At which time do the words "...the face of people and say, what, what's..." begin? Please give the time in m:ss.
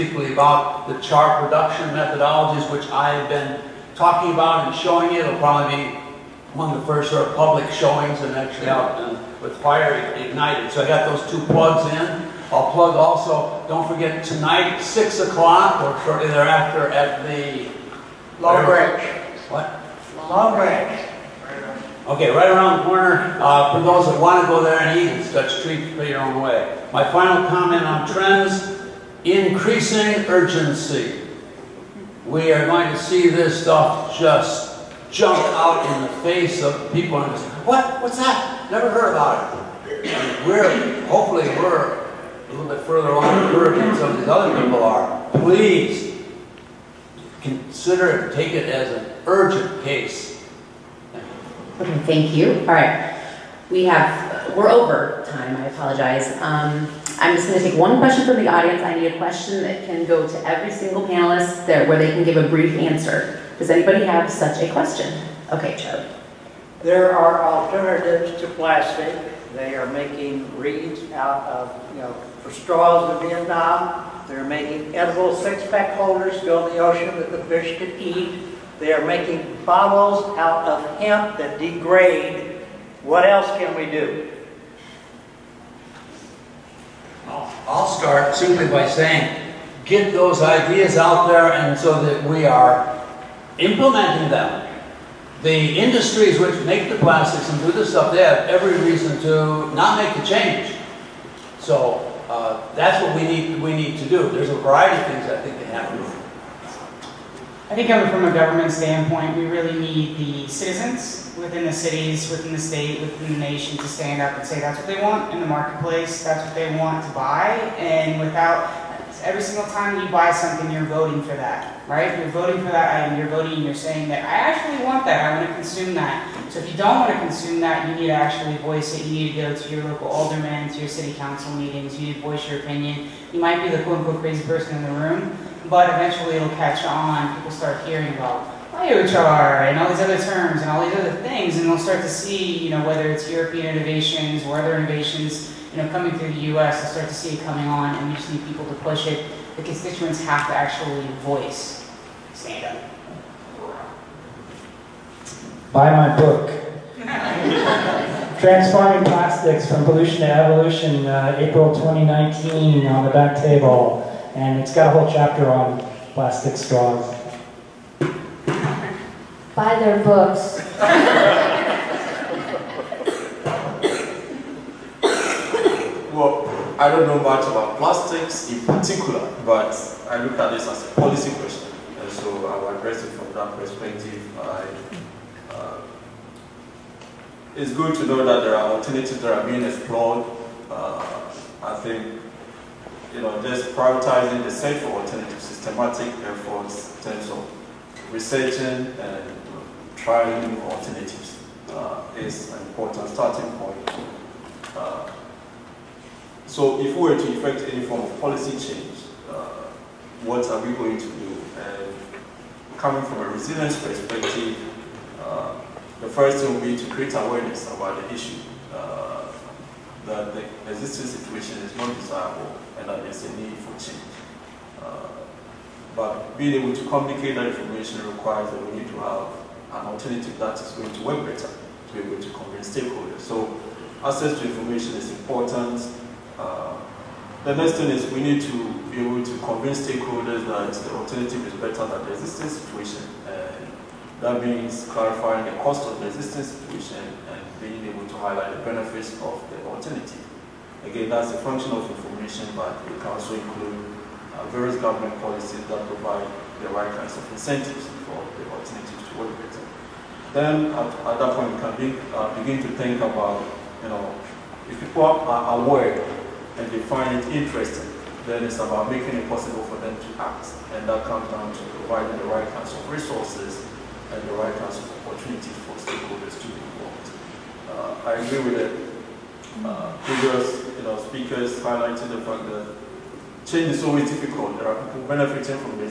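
0:36.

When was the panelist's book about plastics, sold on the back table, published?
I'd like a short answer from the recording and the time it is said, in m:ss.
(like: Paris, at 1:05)
April 2019, at 2:41.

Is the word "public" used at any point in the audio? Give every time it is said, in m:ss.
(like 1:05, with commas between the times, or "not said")
0:07.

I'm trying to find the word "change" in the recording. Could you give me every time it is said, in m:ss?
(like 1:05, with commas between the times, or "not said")
1:40, 3:28, 3:43, 4:43.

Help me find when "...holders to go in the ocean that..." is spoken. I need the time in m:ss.
1:15.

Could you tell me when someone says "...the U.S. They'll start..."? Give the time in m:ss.
2:26.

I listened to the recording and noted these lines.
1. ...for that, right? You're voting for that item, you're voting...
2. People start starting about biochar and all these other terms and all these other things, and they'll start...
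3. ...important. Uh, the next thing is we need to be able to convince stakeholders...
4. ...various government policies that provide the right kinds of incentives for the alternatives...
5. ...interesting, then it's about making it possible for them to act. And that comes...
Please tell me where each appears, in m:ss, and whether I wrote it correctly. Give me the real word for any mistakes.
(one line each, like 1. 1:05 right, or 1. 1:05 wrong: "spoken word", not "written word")
1. 2:01 right
2. 2:17 wrong: "hearing", not "starting"
3. 3:55 right
4. 4:14 right
5. 4:27 right.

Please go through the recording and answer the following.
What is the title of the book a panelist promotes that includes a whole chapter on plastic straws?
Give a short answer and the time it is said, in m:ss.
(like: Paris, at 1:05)
Transforming Plastics from Pollution to Evolution, at 2:38.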